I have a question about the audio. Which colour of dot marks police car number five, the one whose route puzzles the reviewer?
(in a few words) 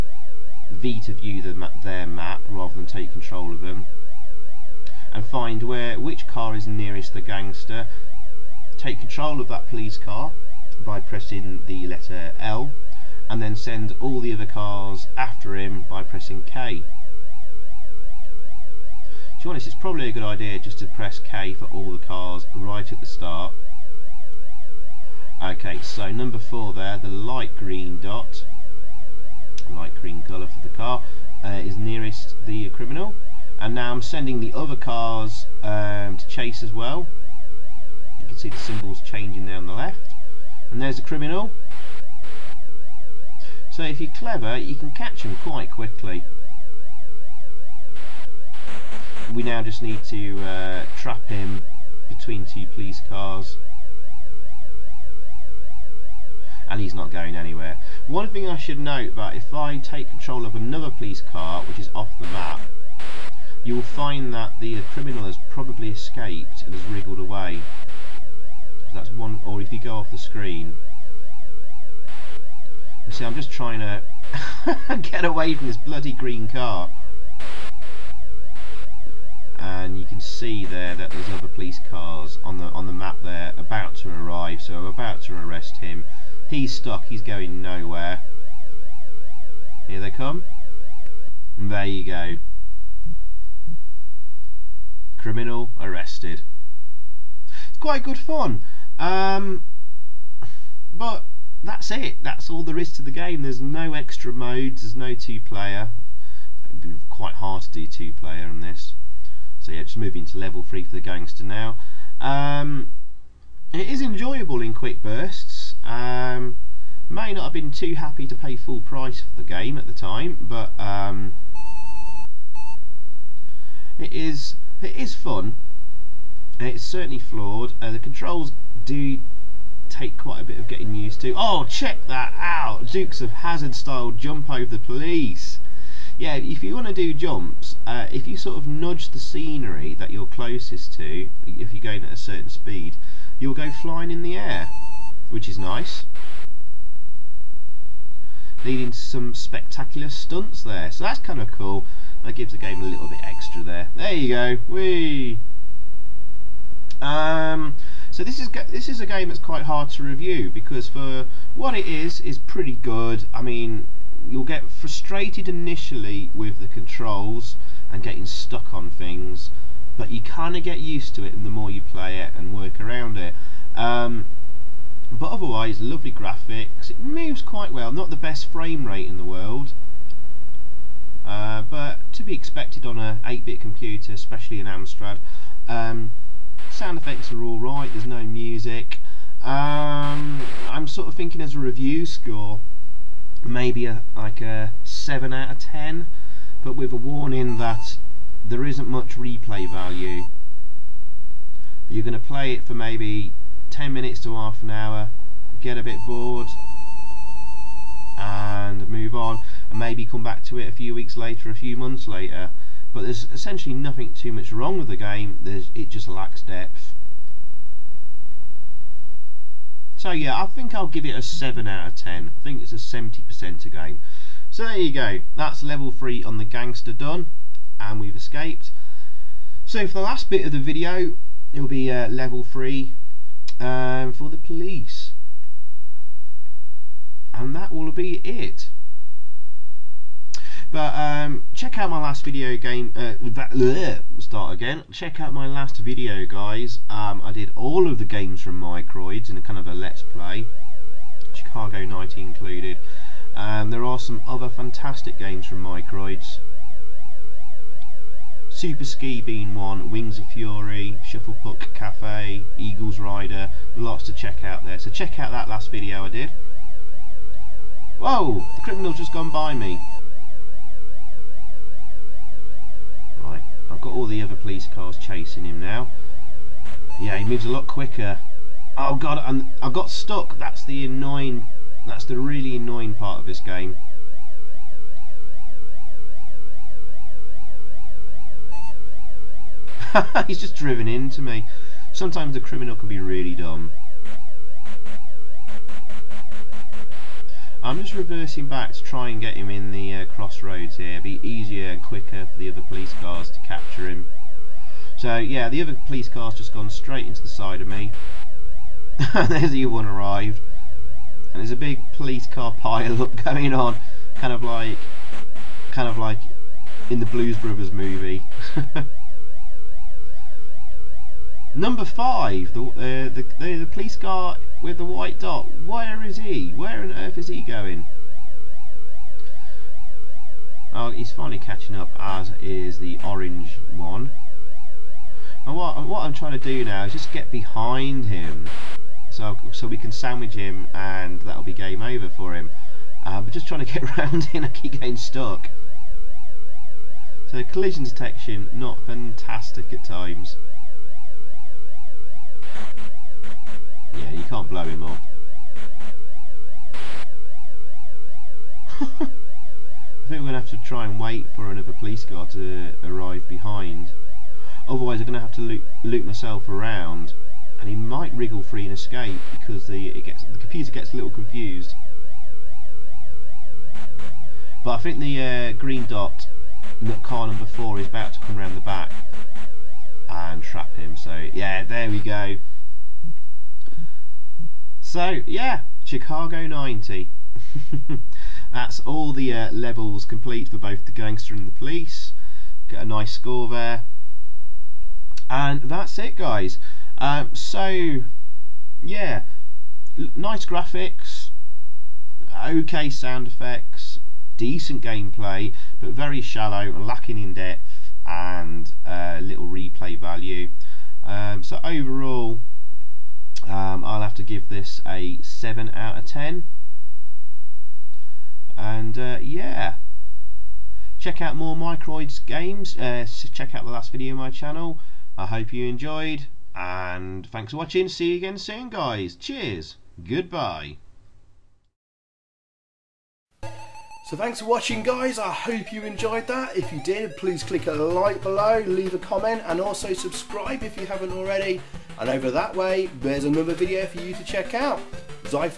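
White.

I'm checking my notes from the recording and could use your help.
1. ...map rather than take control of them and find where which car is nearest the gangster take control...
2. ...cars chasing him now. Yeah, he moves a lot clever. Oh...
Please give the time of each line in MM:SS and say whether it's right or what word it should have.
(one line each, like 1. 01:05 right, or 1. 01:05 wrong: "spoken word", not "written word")
1. 00:02 right
2. 04:34 wrong: "quicker", not "clever".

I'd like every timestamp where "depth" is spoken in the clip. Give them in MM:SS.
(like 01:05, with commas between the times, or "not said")
03:36, 06:47.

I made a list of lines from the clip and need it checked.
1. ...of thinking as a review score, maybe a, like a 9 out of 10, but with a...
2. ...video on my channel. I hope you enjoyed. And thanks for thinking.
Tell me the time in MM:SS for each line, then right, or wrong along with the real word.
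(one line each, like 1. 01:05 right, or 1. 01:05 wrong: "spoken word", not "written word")
1. 03:11 wrong: "7", not "9"
2. 07:03 wrong: "watching", not "thinking".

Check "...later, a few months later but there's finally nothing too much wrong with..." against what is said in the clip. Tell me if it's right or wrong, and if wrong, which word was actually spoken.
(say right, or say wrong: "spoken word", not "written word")
wrong: "essentially", not "finally".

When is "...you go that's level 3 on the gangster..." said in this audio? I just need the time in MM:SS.
03:44.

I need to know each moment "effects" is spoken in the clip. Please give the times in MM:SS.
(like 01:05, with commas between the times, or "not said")
03:06, 06:43.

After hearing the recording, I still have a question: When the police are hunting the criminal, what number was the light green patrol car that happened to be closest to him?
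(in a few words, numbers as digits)
4.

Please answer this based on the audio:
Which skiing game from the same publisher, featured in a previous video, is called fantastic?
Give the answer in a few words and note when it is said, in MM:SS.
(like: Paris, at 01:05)
Super Ski, at 04:18.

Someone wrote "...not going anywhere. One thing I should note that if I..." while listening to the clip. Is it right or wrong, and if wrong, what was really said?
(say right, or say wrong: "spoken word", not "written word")
right.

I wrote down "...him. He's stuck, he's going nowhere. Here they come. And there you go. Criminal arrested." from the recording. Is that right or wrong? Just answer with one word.
right.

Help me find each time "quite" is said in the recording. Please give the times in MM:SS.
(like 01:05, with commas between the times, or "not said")
00:45, 01:37, 01:47, 02:10, 02:39, 02:57.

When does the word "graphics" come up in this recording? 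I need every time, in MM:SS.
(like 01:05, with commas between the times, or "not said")
02:56, 06:40.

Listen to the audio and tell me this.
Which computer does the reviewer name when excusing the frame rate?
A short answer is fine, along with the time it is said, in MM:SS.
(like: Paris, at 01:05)
Amstrad, at 03:04.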